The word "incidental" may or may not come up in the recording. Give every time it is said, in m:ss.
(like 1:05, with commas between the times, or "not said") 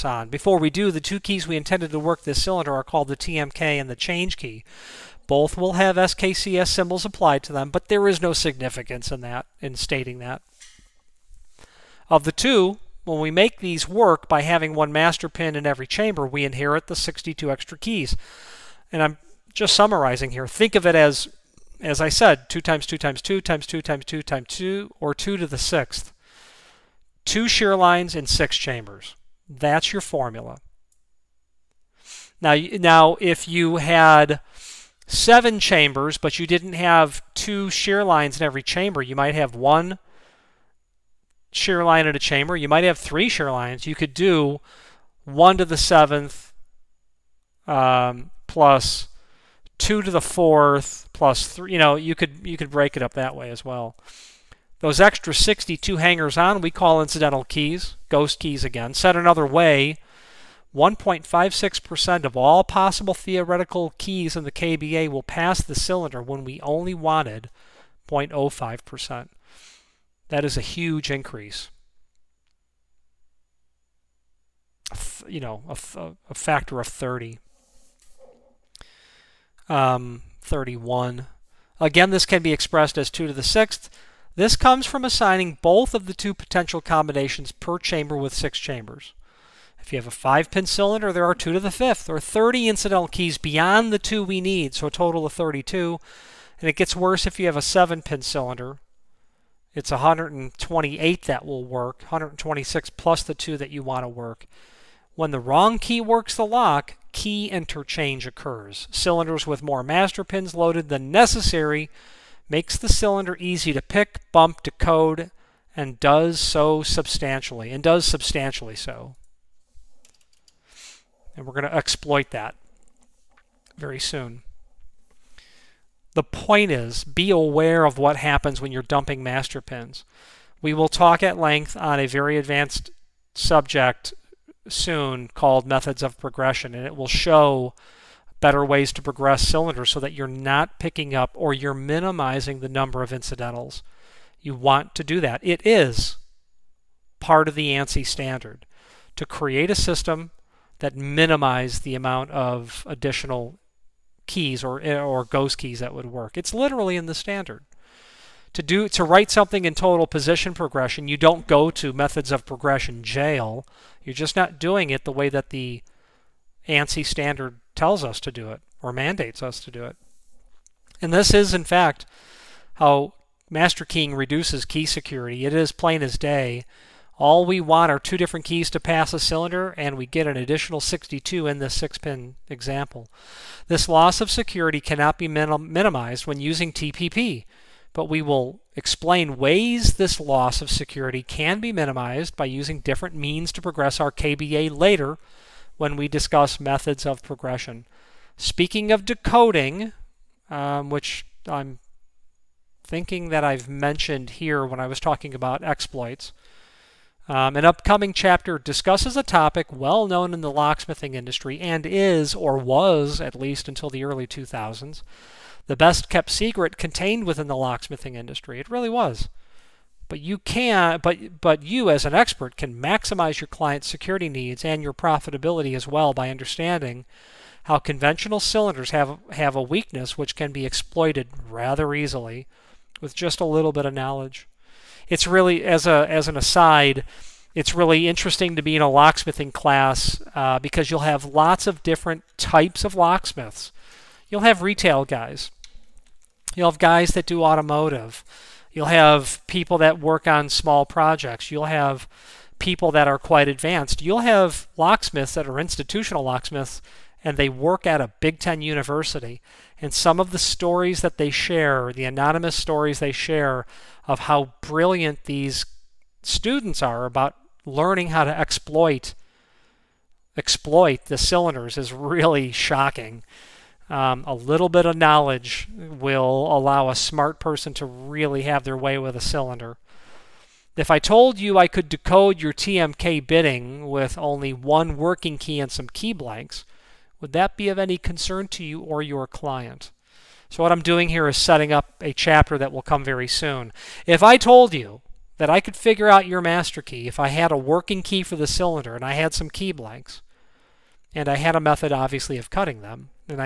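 0:57, 1:32, 2:23.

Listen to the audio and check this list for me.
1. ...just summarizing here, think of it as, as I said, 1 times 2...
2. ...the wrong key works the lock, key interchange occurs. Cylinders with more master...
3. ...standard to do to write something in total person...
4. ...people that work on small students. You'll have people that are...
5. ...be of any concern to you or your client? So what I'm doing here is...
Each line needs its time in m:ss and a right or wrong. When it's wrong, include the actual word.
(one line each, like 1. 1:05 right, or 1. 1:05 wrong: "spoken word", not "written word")
1. 0:19 wrong: "2", not "1"
2. 1:45 right
3. 2:37 wrong: "position", not "person"
4. 4:09 wrong: "projects", not "students"
5. 4:47 right.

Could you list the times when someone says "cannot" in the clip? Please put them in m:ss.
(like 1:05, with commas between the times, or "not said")
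3:04.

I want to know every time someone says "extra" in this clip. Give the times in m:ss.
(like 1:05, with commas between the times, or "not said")
0:17, 0:54.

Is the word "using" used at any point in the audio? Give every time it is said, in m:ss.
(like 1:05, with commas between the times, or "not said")
3:06, 3:12.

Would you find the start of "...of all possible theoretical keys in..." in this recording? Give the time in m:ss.
1:02.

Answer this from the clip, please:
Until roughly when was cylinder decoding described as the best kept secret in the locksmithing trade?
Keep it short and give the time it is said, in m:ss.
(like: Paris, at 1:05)
early 2000s, at 3:34.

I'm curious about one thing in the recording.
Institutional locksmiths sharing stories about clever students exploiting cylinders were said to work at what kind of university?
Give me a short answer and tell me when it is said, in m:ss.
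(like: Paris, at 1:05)
Big Ten, at 4:18.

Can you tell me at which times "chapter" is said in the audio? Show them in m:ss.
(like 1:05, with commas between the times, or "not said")
3:28, 4:52.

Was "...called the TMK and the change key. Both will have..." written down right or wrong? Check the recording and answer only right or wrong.
right.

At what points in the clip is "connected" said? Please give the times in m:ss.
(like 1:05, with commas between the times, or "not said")
not said.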